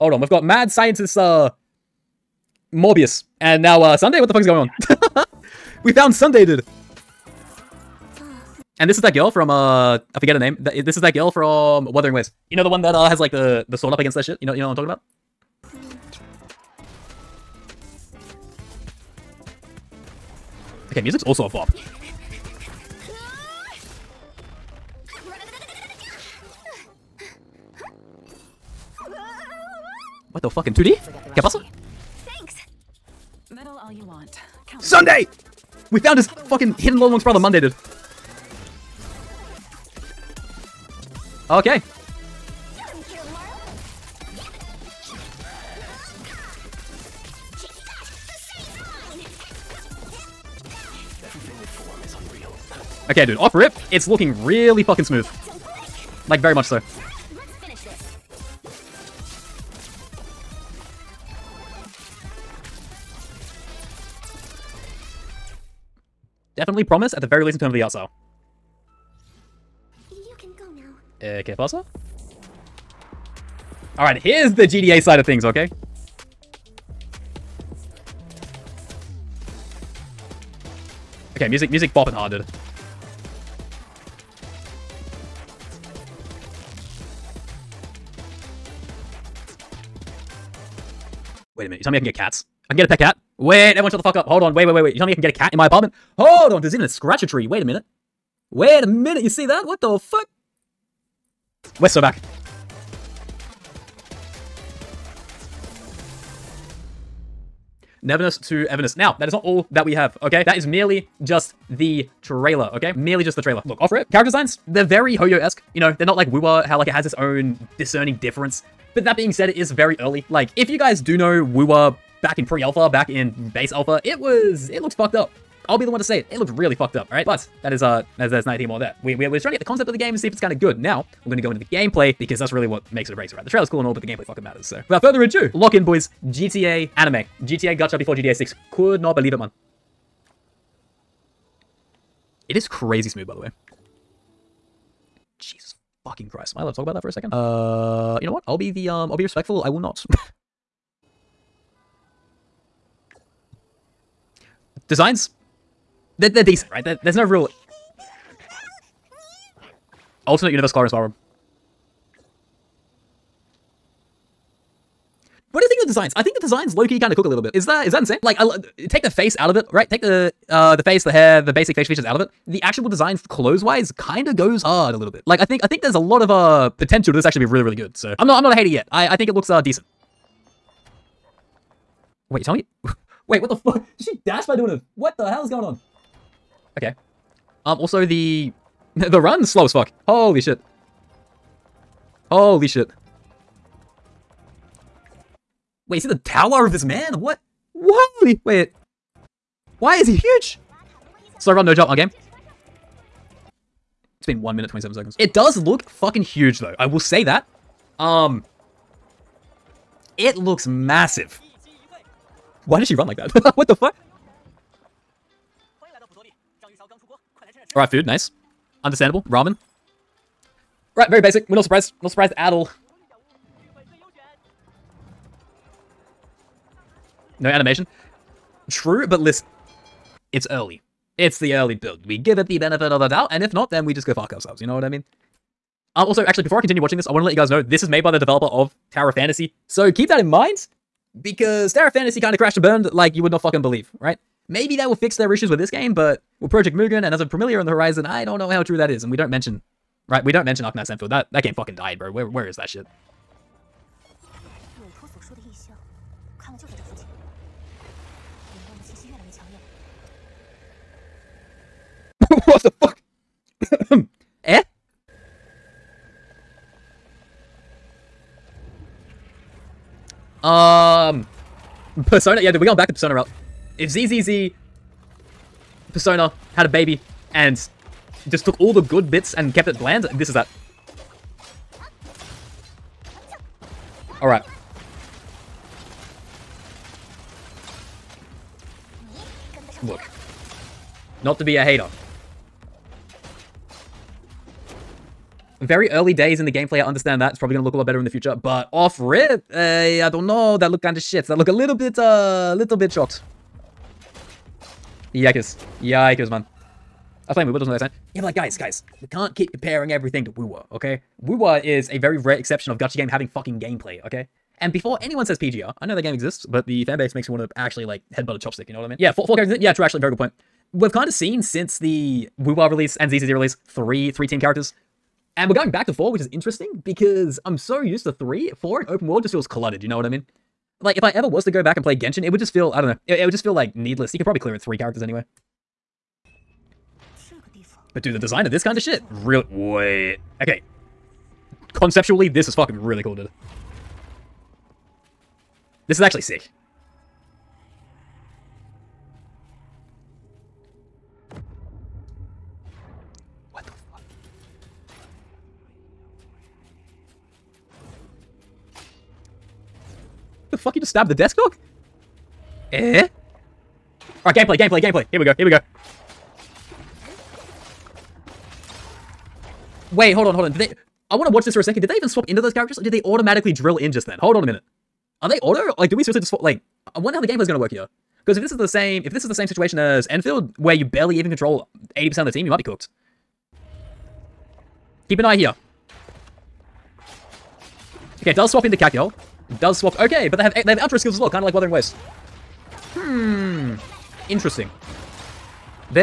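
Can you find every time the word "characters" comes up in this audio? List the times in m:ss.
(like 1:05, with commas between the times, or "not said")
1:54, 5:19, 5:24, 5:34, 6:12.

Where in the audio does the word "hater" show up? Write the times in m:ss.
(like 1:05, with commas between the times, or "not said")
2:58, 4:51.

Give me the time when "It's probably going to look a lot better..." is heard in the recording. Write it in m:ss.
4:57.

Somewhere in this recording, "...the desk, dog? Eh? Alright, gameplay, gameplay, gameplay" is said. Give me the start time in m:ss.
6:01.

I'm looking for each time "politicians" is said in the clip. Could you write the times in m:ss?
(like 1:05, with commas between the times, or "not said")
not said.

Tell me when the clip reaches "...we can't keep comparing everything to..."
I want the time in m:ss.
5:09.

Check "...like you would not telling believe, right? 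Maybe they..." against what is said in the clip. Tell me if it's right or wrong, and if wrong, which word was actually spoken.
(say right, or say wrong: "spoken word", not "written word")
wrong: "fucking", not "telling".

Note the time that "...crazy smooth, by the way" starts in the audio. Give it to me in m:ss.
2:22.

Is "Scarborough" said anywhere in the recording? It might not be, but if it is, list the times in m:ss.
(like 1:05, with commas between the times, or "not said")
not said.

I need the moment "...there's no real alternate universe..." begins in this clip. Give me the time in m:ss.
2:37.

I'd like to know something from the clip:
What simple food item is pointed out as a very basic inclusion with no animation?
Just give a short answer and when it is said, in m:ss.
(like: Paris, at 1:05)
Ramen, at 3:39.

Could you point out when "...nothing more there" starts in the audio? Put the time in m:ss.
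2:08.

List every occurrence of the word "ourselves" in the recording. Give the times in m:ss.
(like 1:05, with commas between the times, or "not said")
3:54.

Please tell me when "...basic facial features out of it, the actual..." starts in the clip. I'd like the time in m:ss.
2:51.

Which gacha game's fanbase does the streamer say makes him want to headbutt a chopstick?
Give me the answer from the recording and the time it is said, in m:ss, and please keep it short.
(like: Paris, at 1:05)
PGR, at 5:15.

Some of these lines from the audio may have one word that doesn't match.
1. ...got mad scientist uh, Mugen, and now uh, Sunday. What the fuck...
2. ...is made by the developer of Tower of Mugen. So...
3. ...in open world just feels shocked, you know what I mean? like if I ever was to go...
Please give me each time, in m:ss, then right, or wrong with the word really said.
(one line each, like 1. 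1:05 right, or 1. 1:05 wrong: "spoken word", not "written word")
1. 0:00 wrong: "Morbius", not "Mugen"
2. 3:57 wrong: "Fantasy", not "Mugen"
3. 5:28 wrong: "cluttered", not "shocked".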